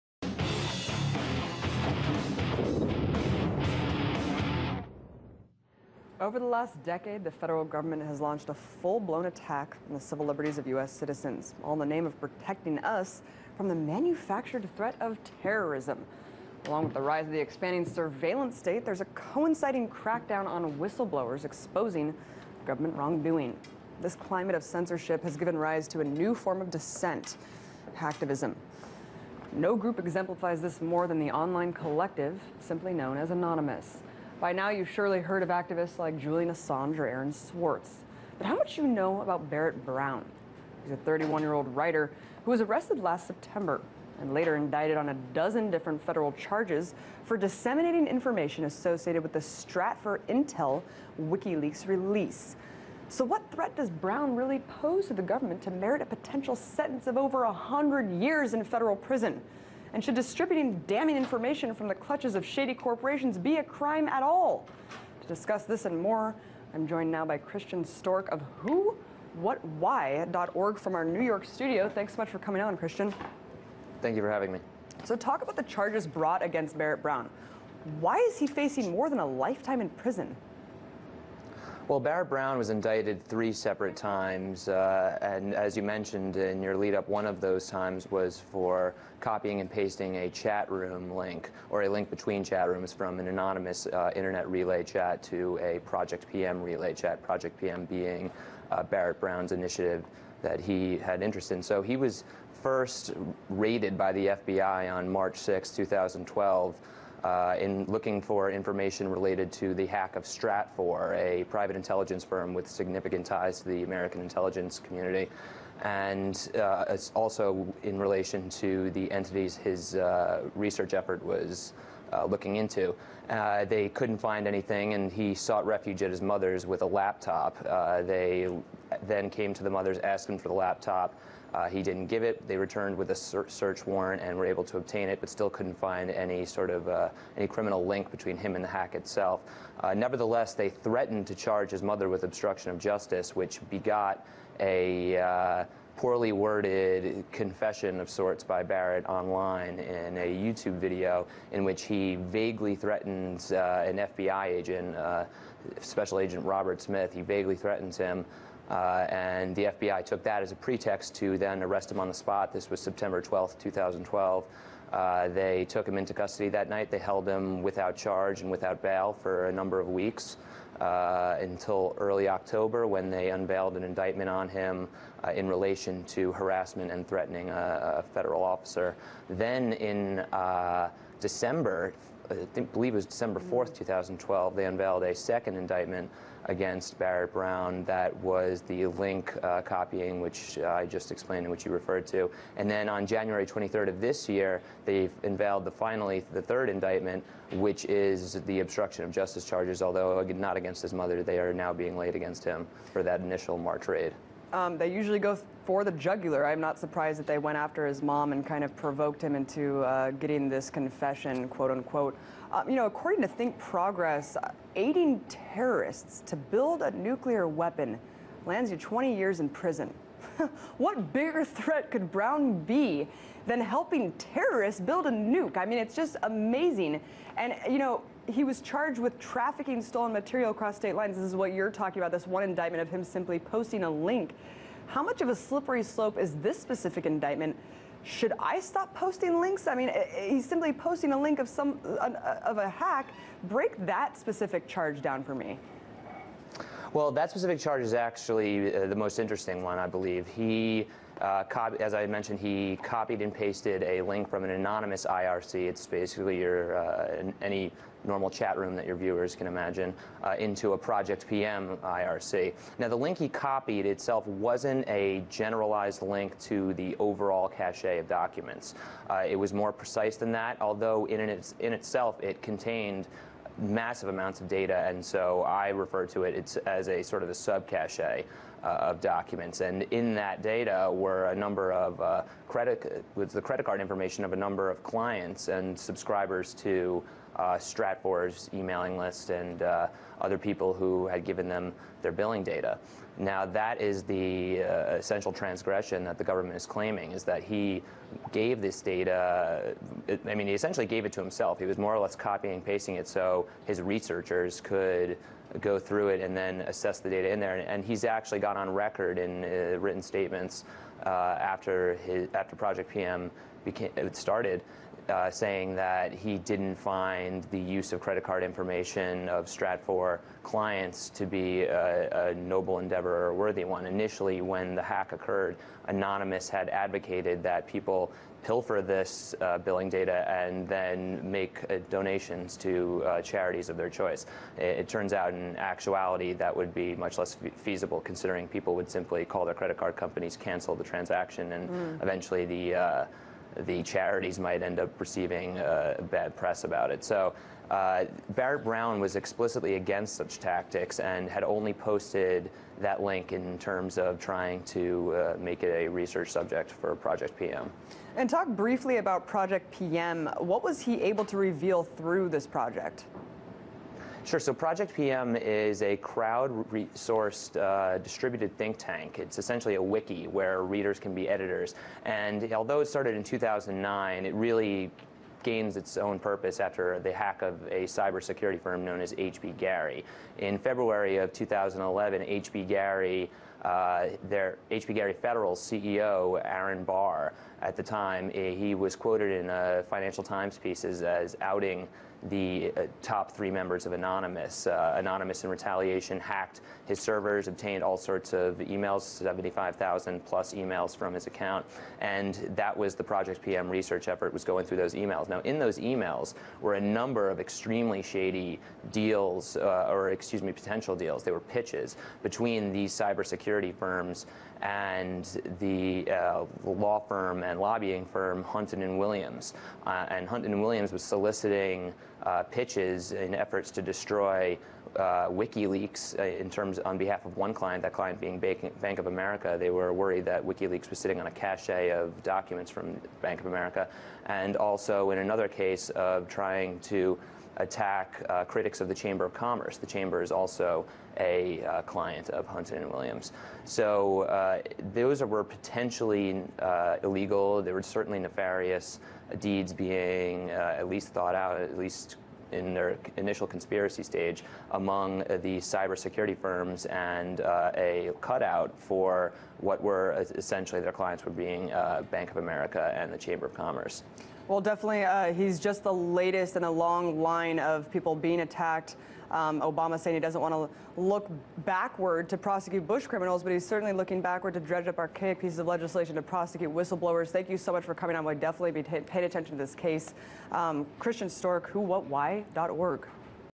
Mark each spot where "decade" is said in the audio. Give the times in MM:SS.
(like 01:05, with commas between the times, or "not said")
00:06.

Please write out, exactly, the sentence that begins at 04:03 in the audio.
Break that specific charge down for me.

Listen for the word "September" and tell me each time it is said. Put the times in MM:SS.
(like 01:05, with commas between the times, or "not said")
00:43, 02:42.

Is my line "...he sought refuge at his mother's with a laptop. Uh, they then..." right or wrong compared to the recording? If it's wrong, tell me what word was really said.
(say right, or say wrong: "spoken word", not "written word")
right.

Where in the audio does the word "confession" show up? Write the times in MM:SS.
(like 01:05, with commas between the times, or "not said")
02:27, 03:30.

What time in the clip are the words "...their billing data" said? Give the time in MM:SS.
04:52.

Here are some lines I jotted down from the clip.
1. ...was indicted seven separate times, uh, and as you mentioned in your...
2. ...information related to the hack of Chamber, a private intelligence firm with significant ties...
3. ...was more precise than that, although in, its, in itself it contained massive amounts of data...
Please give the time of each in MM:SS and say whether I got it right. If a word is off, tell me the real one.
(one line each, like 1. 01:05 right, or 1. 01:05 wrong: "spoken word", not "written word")
1. 01:22 wrong: "three", not "seven"
2. 01:48 wrong: "Stratfor", not "Chamber"
3. 04:29 right.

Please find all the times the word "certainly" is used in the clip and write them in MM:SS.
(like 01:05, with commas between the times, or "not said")
07:27, 07:53.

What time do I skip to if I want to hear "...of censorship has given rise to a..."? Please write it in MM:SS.
00:24.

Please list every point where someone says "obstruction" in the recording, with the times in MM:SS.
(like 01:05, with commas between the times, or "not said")
02:22, 03:18.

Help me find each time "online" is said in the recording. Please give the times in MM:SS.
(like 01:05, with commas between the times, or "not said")
00:31, 02:29.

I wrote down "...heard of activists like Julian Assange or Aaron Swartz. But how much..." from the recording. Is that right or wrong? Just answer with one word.
right.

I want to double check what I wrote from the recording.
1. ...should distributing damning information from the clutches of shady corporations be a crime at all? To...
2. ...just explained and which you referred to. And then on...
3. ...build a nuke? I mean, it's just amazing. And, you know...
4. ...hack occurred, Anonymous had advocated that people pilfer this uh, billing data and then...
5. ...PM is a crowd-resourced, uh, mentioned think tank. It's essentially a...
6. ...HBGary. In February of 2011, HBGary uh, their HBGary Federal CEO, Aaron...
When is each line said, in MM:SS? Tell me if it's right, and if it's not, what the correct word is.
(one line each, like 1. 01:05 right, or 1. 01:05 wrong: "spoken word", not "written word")
1. 01:00 right
2. 03:10 right
3. 03:44 right
4. 05:24 right
5. 06:04 wrong: "distributed", not "mentioned"
6. 06:19 right.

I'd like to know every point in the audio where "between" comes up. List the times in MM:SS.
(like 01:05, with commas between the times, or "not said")
01:32, 02:18, 06:52.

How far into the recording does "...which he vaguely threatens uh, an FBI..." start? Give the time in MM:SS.
02:31.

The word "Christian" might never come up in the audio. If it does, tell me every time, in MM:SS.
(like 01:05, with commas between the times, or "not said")
01:07, 01:12, 08:00.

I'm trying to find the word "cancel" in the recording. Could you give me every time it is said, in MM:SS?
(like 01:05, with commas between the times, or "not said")
05:40.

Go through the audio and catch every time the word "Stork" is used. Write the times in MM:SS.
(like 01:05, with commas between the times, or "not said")
01:07, 08:01.